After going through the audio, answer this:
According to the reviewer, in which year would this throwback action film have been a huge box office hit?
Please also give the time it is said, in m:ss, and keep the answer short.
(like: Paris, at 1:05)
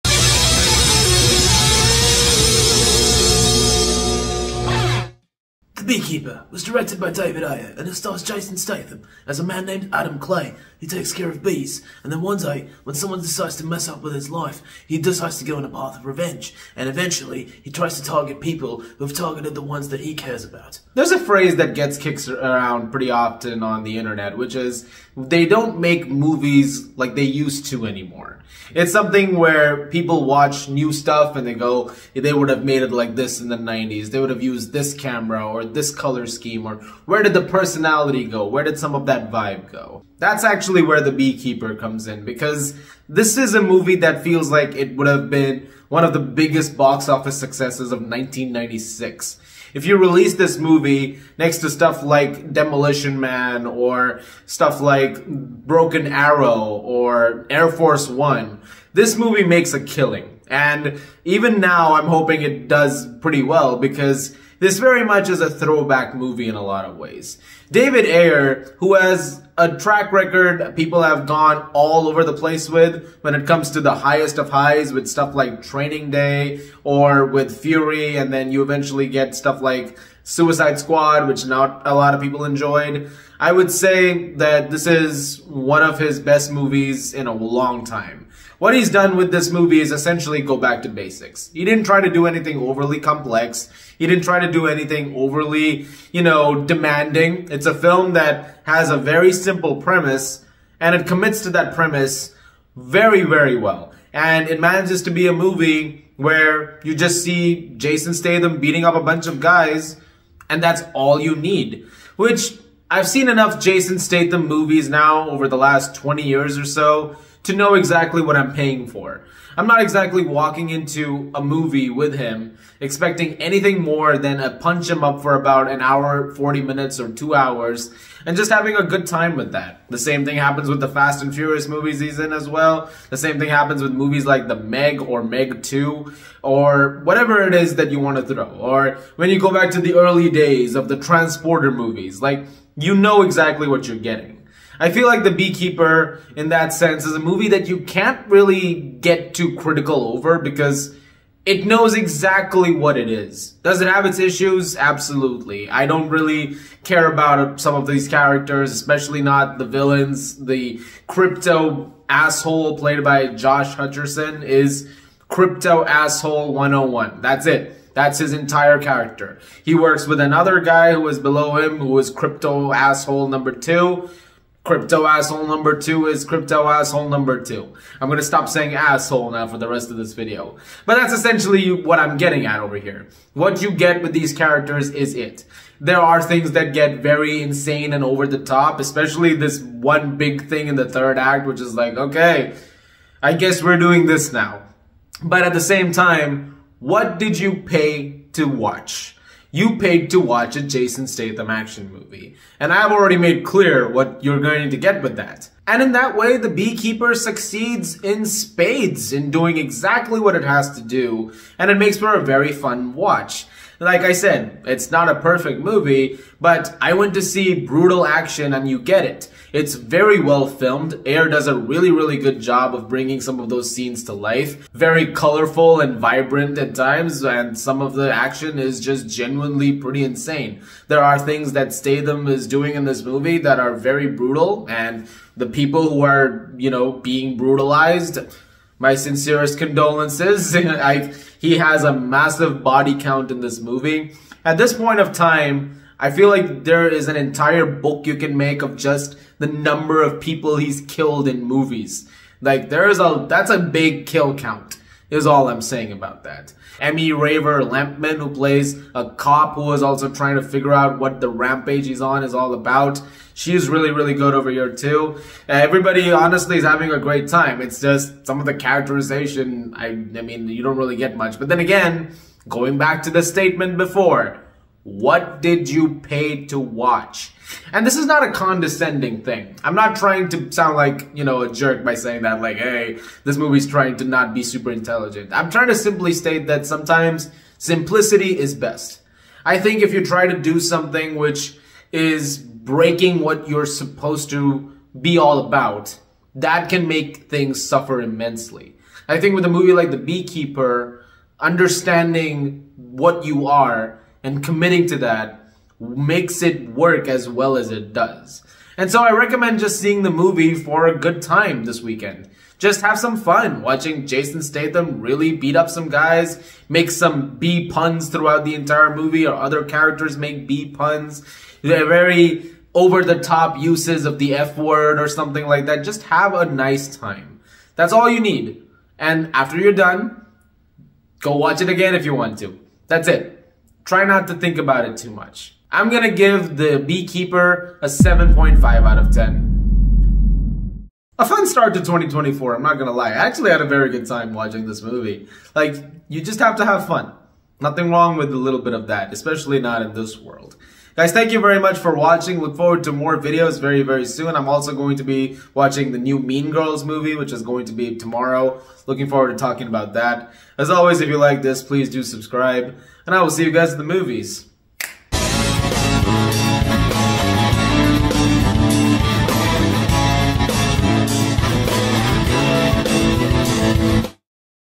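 1996, at 0:48.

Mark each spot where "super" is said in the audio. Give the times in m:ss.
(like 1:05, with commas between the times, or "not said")
4:44.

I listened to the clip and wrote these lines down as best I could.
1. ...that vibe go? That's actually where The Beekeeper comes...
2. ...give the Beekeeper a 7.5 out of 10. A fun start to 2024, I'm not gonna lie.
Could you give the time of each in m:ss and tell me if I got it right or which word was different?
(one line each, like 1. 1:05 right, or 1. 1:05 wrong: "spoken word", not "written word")
1. 0:39 right
2. 5:36 right.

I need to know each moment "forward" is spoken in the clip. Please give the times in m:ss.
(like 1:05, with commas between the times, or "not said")
5:52, 5:59.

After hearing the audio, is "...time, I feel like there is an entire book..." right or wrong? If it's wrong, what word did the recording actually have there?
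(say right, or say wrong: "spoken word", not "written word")
right.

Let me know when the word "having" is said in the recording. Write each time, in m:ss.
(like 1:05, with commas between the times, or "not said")
2:08, 4:26.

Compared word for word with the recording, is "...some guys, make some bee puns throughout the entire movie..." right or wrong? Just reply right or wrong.
right.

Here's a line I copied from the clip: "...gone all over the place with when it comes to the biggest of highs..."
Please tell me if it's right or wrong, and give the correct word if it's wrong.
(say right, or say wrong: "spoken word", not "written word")
wrong: "highest", not "biggest".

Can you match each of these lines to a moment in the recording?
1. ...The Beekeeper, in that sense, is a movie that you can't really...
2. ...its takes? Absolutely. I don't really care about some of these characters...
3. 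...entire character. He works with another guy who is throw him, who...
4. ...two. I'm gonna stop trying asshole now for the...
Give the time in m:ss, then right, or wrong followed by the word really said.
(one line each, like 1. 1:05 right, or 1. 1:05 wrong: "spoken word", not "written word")
1. 2:25 right
2. 2:34 wrong: "issues", not "takes"
3. 2:48 wrong: "below", not "throw"
4. 2:57 wrong: "saying", not "trying".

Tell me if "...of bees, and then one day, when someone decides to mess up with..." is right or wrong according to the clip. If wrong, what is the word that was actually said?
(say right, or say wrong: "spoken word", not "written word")
right.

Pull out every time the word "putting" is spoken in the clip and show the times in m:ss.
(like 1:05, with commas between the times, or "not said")
not said.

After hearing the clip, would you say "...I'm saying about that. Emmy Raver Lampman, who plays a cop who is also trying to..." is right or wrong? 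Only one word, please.
right.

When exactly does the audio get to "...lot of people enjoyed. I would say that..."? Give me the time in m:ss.
1:21.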